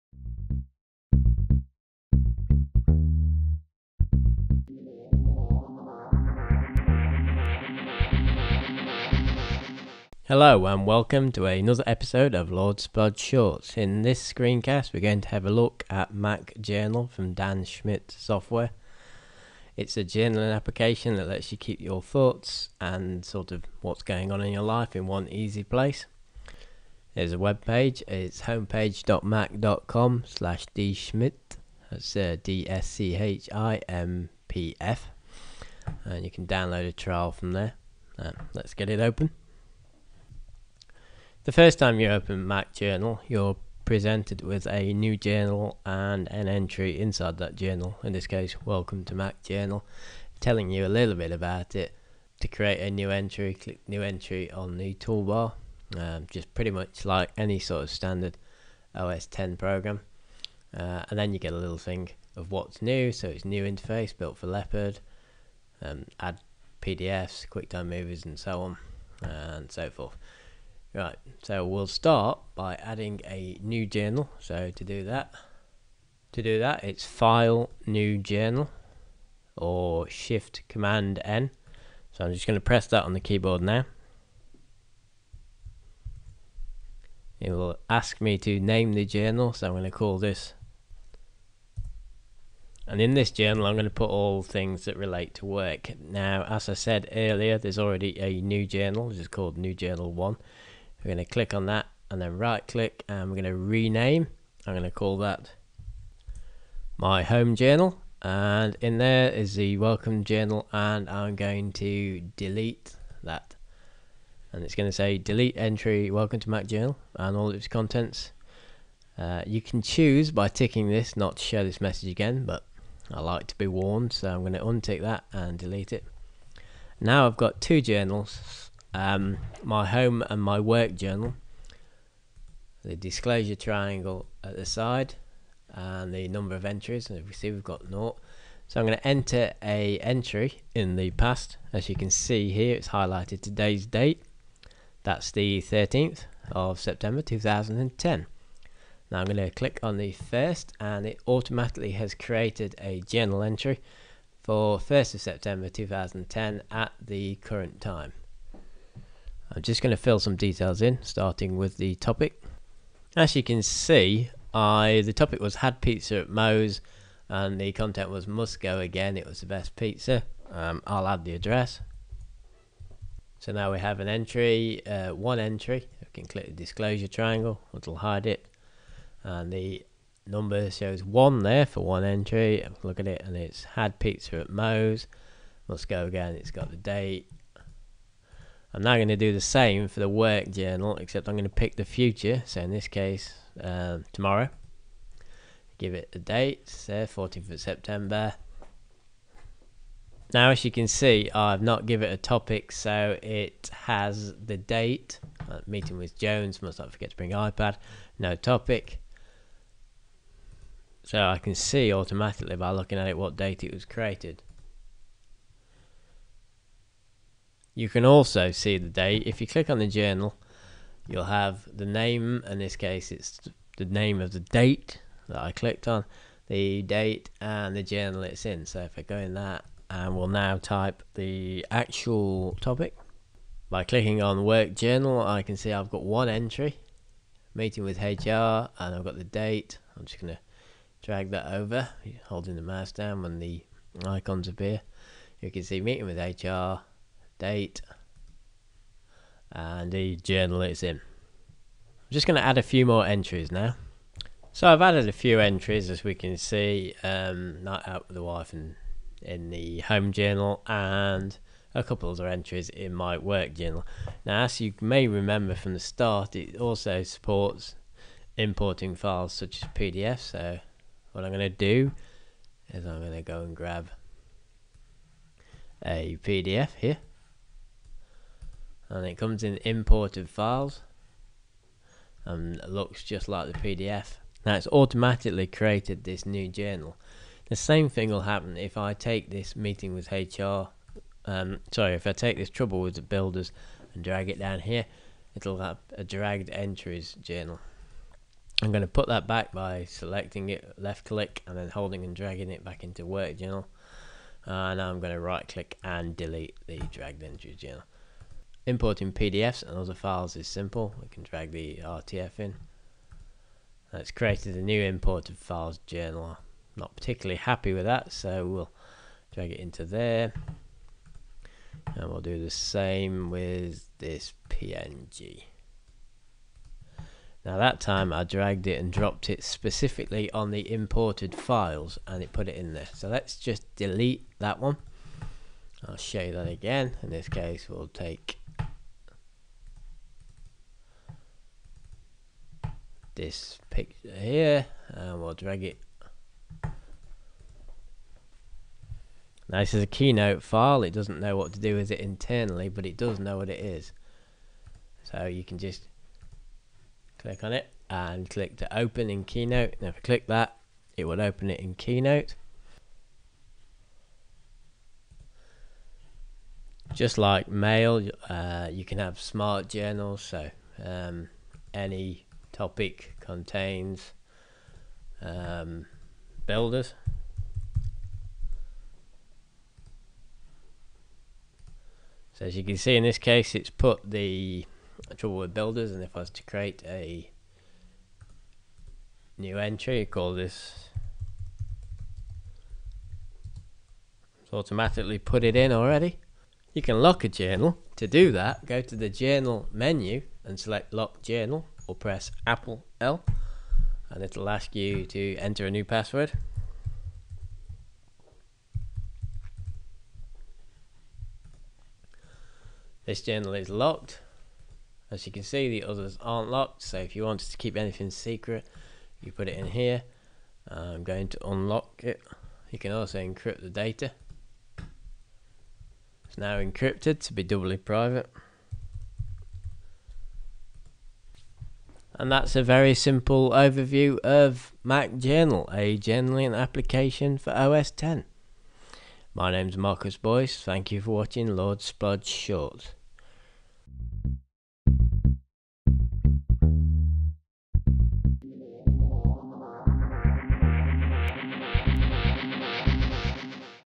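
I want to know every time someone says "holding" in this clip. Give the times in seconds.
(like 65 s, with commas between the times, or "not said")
242 s, 301 s.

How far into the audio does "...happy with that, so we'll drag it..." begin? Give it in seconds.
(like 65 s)
317 s.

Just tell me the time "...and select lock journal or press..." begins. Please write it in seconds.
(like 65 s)
400 s.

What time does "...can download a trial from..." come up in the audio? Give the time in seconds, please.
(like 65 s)
36 s.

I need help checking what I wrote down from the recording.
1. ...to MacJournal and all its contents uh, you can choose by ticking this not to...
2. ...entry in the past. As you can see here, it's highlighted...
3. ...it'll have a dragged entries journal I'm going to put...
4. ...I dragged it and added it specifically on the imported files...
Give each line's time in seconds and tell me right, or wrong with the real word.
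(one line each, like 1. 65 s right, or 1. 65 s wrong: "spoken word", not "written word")
1. 116 s right
2. 139 s right
3. 295 s right
4. 328 s wrong: "dropped", not "added".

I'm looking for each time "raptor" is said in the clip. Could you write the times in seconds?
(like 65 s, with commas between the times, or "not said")
not said.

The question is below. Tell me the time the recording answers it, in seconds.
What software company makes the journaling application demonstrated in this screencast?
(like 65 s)
17 s.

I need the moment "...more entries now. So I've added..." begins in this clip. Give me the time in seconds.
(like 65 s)
252 s.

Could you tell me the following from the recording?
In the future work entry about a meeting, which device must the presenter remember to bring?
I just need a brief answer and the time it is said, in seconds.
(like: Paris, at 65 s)
iPad, at 207 s.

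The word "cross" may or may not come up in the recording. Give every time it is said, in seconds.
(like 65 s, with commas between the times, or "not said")
not said.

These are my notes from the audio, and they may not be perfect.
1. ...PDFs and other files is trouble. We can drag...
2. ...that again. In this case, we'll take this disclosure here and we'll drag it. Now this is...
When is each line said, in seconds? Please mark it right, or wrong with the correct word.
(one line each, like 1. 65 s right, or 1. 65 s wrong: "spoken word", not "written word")
1. 309 s wrong: "simple", not "trouble"
2. 336 s wrong: "picture", not "disclosure".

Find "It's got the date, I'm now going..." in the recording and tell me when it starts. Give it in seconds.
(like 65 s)
186 s.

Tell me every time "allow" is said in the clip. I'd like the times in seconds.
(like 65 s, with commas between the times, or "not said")
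not said.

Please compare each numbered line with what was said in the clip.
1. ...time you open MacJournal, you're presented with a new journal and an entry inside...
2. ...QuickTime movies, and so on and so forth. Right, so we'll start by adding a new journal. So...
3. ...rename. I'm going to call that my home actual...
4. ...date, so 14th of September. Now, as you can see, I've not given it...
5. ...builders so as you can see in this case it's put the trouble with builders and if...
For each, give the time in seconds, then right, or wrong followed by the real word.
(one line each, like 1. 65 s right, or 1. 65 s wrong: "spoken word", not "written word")
1. 41 s right
2. 67 s right
3. 103 s wrong: "journal", not "actual"
4. 196 s right
5. 376 s right.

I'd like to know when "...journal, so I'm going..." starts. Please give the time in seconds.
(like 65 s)
89 s.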